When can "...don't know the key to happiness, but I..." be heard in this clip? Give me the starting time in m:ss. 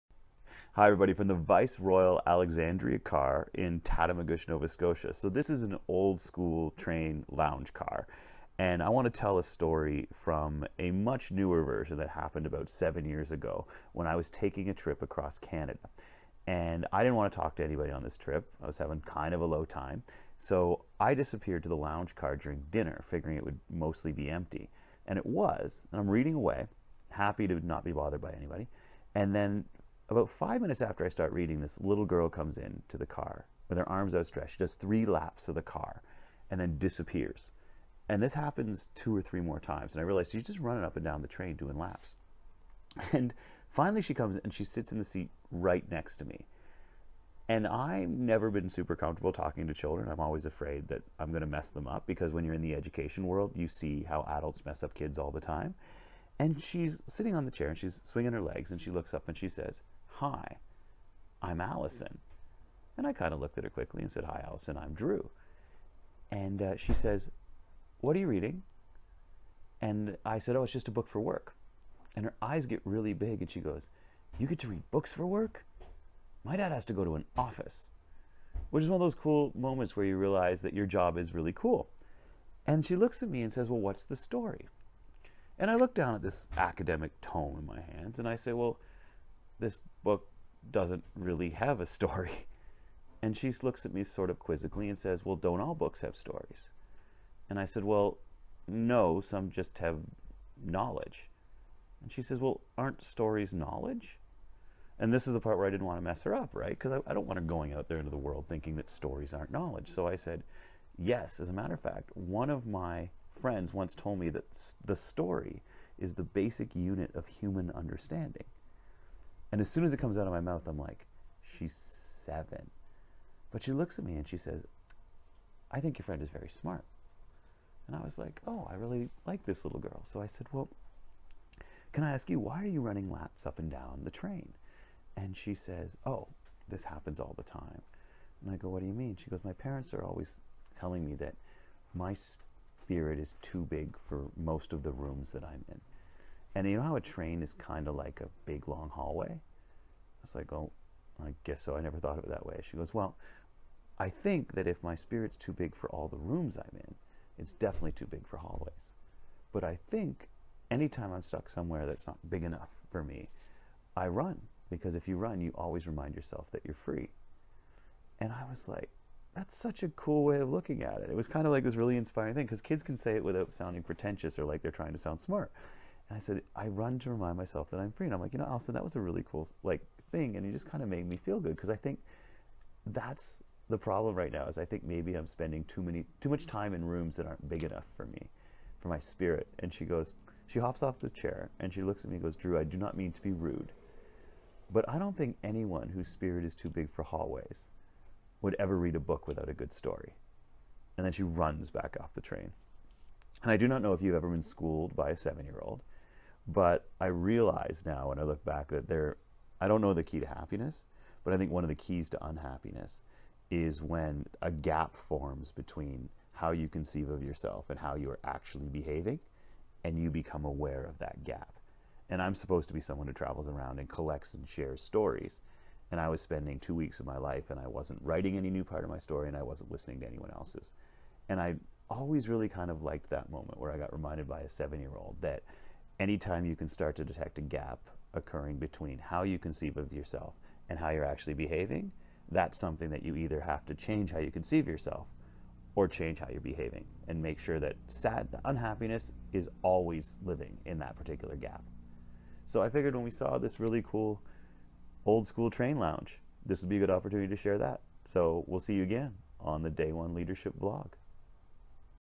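3:29.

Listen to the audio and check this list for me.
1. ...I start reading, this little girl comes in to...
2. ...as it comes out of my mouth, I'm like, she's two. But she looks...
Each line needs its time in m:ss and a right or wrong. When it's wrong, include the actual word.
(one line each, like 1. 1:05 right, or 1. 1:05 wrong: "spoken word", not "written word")
1. 0:31 right
2. 1:59 wrong: "seven", not "two".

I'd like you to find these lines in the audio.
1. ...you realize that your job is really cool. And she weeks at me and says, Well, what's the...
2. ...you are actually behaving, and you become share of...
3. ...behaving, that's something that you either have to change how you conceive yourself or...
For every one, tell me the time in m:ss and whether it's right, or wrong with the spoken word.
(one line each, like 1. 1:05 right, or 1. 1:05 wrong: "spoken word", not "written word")
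1. 1:20 wrong: "looks", not "weeks"
2. 3:37 wrong: "aware", not "share"
3. 4:01 right.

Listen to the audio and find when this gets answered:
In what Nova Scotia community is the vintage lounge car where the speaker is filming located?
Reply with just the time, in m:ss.
0:03.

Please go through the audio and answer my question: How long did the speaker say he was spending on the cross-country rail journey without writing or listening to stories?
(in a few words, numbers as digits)
2 weeks.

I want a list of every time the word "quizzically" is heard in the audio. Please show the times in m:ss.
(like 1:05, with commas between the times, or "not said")
1:34.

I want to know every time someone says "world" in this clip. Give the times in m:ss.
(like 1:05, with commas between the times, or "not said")
0:53, 1:48.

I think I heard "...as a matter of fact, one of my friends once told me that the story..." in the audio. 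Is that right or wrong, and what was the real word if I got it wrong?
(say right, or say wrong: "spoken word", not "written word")
right.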